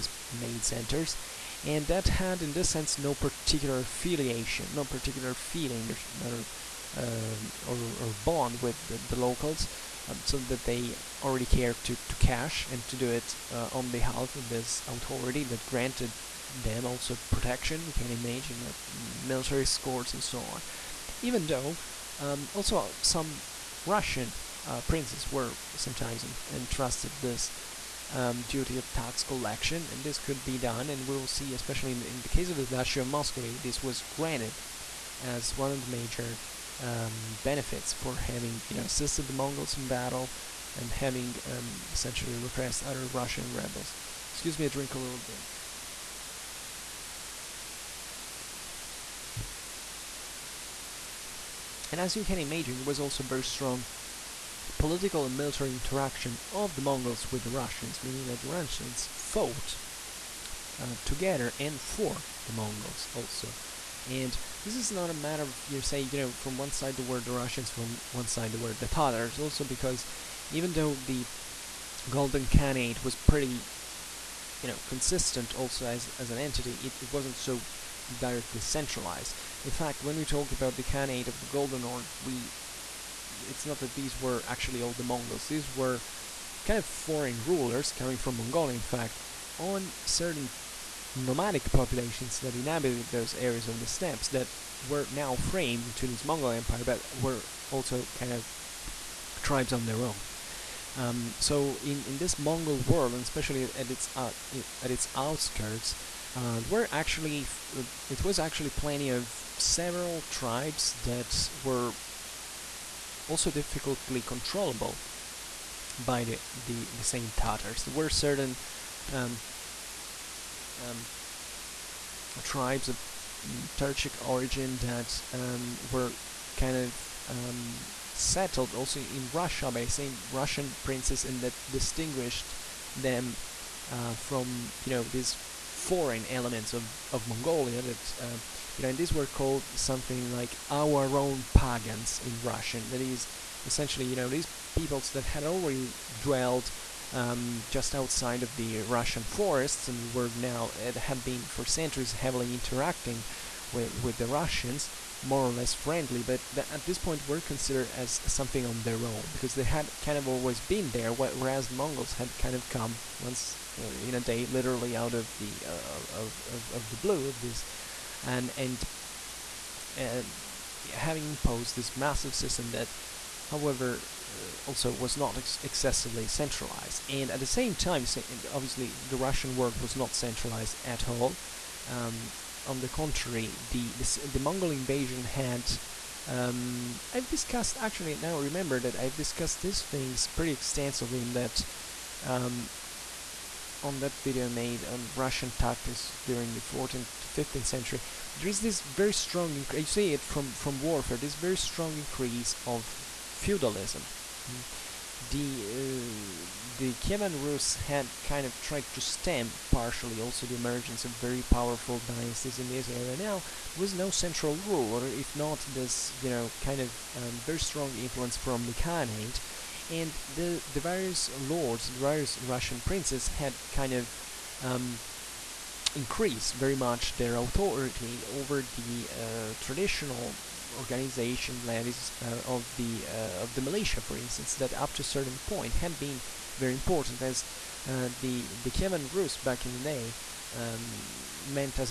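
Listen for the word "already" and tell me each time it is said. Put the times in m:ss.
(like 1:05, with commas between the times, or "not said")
0:11, 2:25.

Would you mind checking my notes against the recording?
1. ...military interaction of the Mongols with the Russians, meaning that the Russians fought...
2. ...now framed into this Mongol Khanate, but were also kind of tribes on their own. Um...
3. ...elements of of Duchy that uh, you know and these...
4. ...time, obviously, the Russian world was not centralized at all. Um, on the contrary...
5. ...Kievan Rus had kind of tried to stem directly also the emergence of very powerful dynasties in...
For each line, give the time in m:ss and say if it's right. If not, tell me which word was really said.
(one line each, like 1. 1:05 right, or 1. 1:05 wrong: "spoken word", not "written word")
1. 0:55 right
2. 1:35 wrong: "Empire", not "Khanate"
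3. 2:16 wrong: "Mongolia", not "Duchy"
4. 2:57 right
5. 3:26 wrong: "partially", not "directly".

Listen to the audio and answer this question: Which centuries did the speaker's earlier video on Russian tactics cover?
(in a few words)
14th to 15th century.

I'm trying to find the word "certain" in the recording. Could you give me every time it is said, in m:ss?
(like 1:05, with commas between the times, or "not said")
1:30, 1:58, 3:55.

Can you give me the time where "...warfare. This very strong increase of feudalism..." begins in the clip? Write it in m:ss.
3:20.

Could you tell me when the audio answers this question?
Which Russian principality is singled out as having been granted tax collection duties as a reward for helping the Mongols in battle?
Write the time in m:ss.
0:32.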